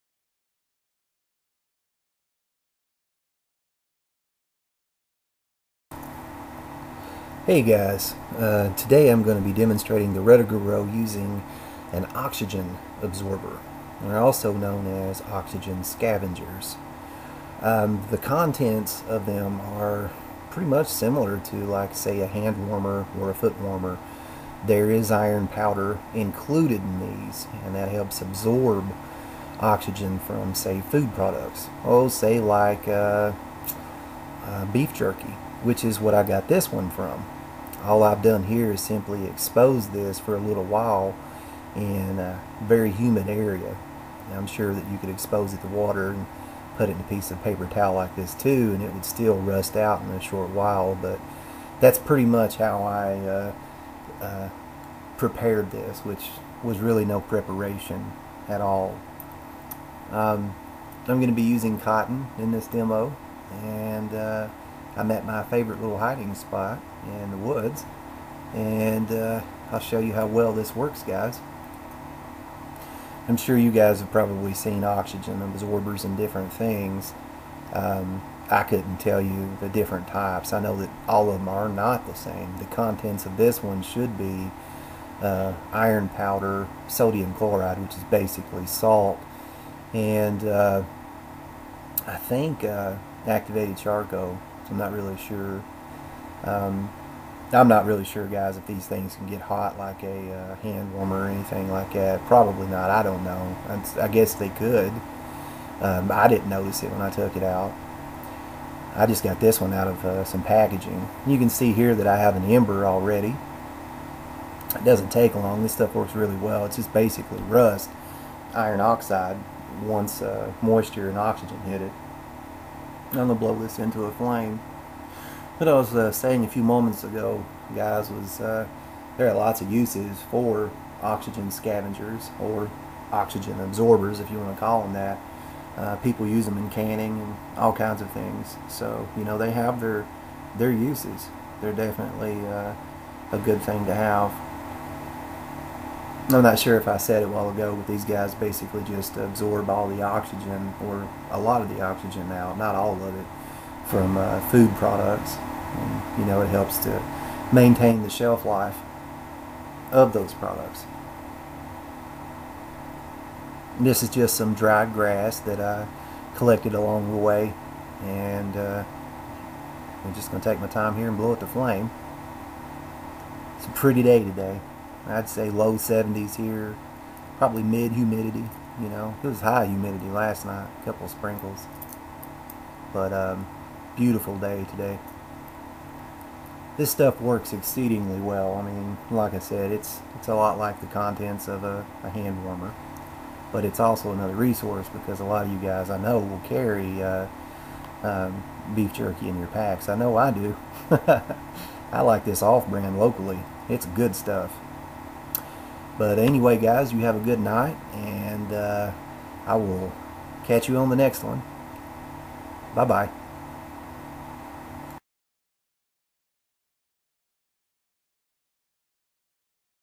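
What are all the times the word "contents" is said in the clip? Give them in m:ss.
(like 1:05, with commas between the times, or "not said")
0:18, 1:22, 3:10.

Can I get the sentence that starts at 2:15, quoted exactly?
Uh, people use them in canning and all kinds of things.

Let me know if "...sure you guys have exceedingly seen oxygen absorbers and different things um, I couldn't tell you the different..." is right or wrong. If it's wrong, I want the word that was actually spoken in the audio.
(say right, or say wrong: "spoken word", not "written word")
wrong: "probably", not "exceedingly".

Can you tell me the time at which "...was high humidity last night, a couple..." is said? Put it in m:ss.
2:59.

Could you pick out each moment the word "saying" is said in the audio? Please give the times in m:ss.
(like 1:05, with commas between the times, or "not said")
2:06.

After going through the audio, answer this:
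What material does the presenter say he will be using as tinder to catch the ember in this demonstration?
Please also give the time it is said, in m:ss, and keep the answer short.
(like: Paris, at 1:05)
cotton, at 1:01.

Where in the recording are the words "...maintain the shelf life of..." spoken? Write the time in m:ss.
2:37.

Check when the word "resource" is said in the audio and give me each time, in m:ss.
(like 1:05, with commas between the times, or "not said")
3:14.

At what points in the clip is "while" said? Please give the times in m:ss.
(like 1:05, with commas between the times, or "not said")
0:40, 0:50, 2:27.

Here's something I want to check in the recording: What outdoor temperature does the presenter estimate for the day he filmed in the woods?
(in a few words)
low 70s.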